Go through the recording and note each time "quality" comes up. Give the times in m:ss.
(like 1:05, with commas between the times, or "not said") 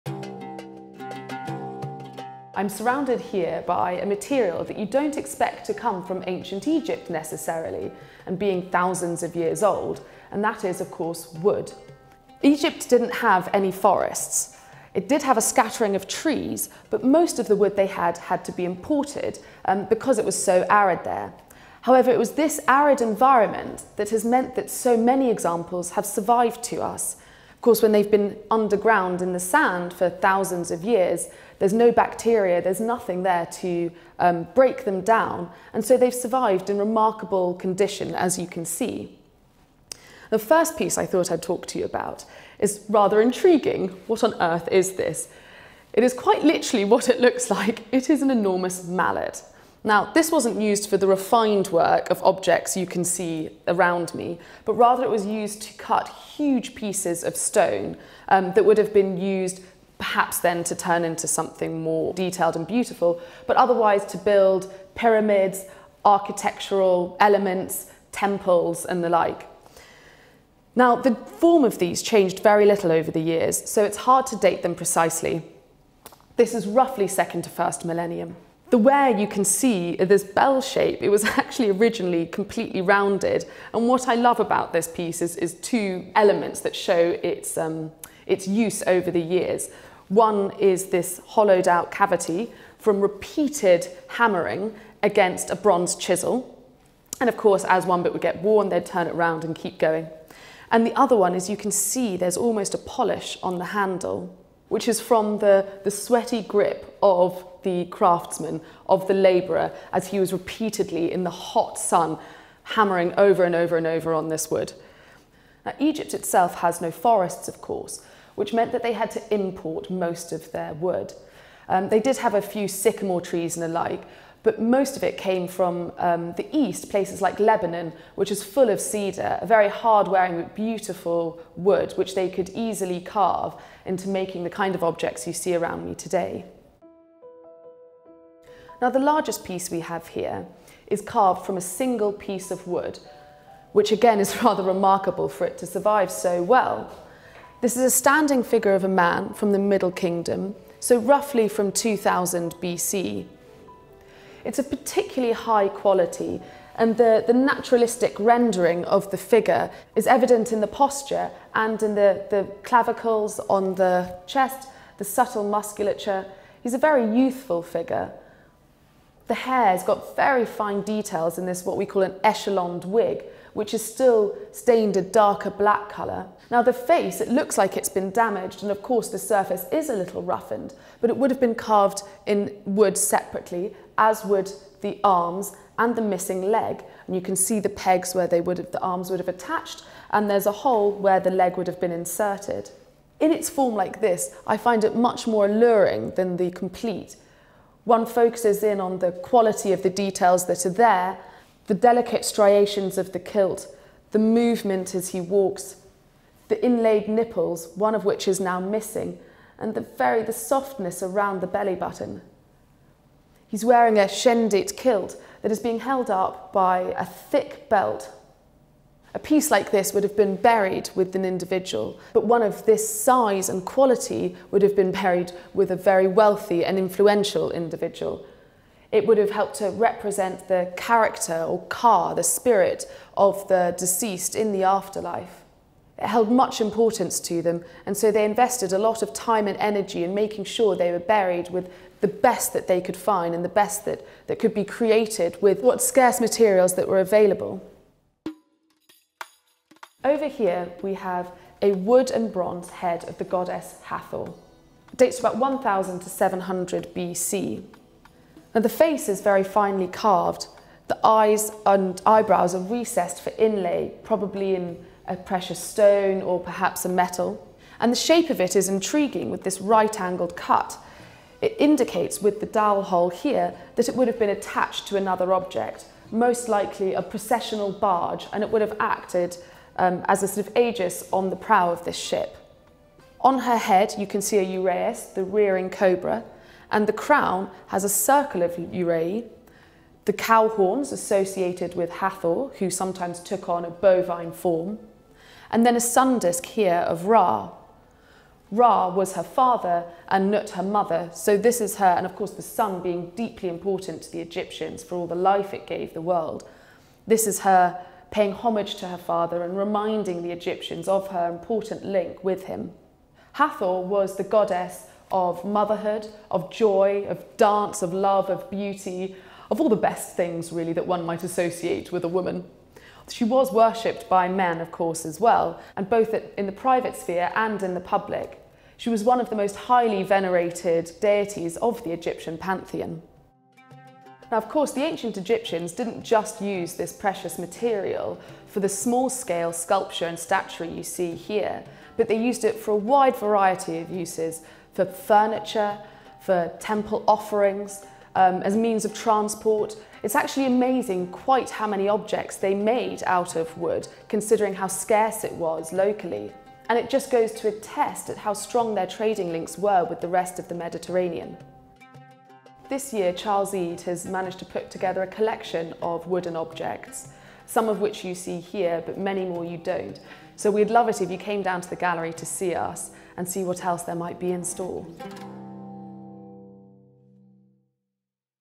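2:35, 3:19, 3:43.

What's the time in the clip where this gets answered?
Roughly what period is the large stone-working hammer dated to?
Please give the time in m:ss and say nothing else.
1:17.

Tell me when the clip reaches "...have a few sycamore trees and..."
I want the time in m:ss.
2:02.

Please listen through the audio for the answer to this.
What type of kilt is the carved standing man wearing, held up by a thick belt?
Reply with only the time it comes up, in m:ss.
3:34.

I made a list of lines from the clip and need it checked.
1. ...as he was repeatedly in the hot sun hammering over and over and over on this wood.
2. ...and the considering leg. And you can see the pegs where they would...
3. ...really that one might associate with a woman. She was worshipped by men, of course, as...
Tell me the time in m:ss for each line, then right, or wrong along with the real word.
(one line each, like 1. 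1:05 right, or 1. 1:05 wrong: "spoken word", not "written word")
1. 1:49 right
2. 3:05 wrong: "missing", not "considering"
3. 5:20 right.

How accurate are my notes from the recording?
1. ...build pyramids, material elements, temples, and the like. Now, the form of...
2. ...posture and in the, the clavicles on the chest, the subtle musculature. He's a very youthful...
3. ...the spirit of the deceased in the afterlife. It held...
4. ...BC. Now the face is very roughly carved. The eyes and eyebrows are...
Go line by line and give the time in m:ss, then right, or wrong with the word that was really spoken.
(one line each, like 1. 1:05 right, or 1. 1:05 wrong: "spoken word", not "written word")
1. 1:04 wrong: "architectural", not "material"
2. 2:40 right
3. 3:52 right
4. 4:16 wrong: "finely", not "roughly".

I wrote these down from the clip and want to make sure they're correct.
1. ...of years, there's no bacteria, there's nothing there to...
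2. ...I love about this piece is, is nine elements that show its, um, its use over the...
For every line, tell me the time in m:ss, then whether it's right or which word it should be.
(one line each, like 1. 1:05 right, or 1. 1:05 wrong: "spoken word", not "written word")
1. 0:30 right
2. 1:24 wrong: "two", not "nine".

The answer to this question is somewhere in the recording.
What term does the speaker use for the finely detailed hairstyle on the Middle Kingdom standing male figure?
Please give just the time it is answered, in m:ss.
2:52.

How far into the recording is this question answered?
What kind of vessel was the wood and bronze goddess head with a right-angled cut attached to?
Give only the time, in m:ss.
4:37.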